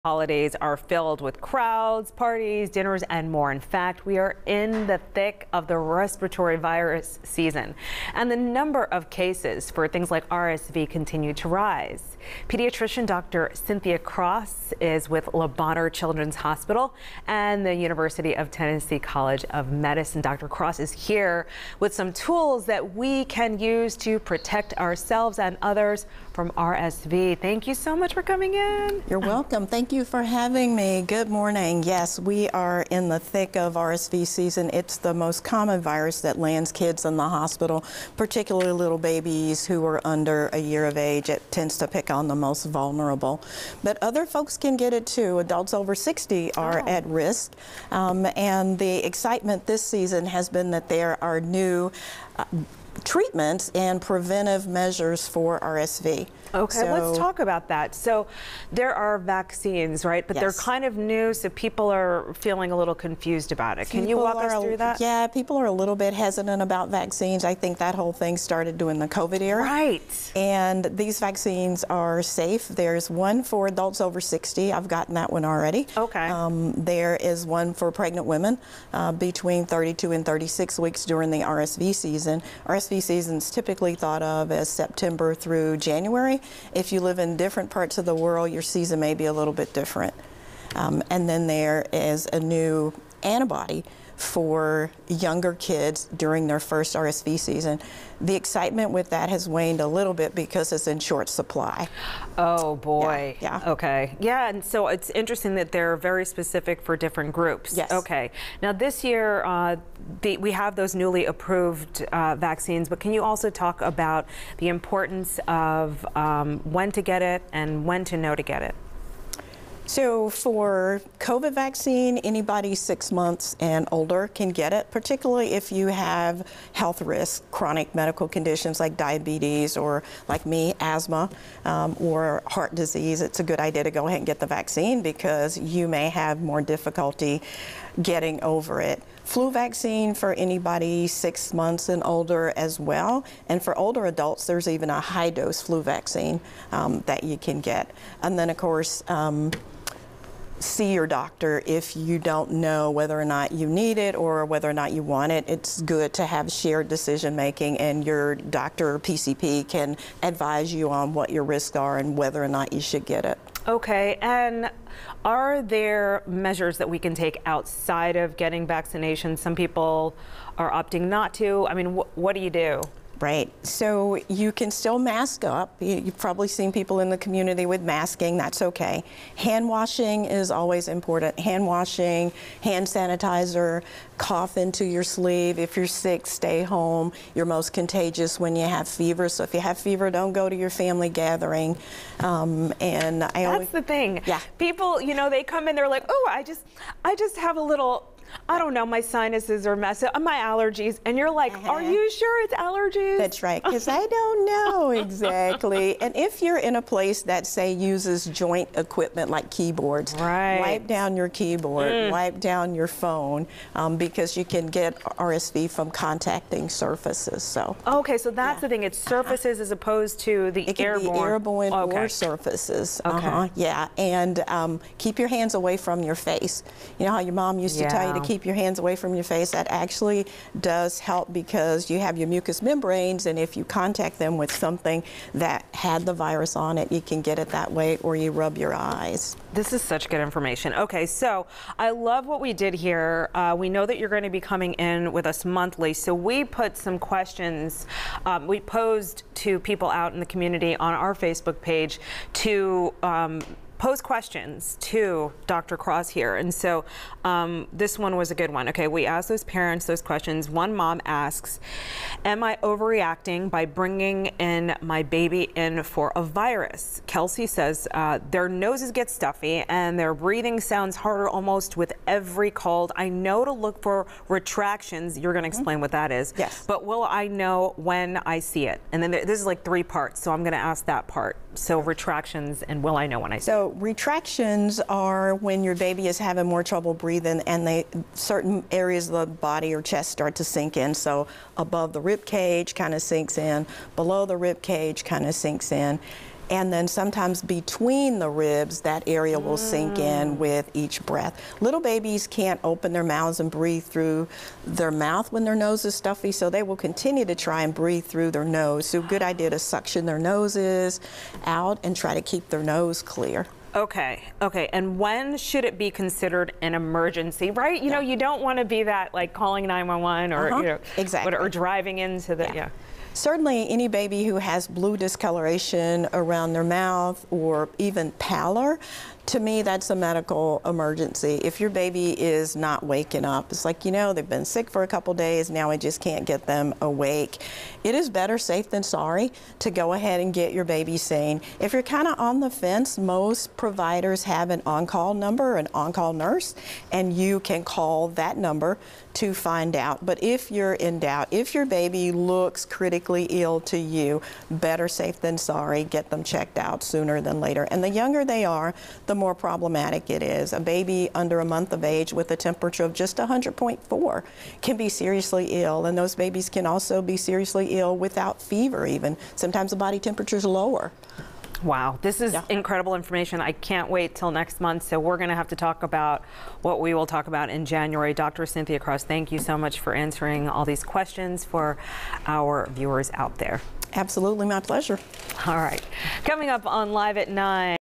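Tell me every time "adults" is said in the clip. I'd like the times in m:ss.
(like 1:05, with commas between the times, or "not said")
0:45, 1:13, 2:24.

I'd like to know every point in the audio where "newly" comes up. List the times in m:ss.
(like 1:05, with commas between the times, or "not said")
1:50.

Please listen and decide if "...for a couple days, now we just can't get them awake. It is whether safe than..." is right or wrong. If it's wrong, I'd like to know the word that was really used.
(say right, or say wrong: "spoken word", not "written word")
wrong: "better", not "whether".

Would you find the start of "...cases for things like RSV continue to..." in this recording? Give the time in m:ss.
0:09.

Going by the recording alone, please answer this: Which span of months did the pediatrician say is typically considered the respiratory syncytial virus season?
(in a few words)
September through January.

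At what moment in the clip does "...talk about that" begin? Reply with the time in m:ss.
0:57.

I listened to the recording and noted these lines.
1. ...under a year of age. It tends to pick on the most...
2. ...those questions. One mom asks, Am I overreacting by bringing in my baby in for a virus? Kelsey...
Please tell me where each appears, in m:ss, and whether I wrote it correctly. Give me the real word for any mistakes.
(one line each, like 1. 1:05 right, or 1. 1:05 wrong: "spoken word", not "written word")
1. 0:40 right
2. 4:19 right.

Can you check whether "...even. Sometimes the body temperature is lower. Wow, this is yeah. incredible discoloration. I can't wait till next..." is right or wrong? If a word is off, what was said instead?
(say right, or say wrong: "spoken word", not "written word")
wrong: "information", not "discoloration".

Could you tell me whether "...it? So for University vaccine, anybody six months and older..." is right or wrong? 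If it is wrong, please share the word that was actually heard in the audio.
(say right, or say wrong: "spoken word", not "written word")
wrong: "COVID", not "University".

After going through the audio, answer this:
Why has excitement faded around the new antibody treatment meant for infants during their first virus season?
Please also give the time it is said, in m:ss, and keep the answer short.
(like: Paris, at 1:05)
Short supply, at 1:40.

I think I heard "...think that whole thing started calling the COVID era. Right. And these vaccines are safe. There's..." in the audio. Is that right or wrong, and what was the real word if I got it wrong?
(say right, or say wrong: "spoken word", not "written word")
wrong: "during", not "calling".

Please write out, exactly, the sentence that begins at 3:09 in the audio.
So if you have fever, don't go to your family gathering.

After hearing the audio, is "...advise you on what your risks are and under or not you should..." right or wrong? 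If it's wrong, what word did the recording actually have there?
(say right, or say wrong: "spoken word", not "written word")
wrong: "whether", not "under".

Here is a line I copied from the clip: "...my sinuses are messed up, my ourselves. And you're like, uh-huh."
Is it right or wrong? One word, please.
wrong.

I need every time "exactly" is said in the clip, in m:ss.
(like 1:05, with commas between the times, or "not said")
3:24, 5:21.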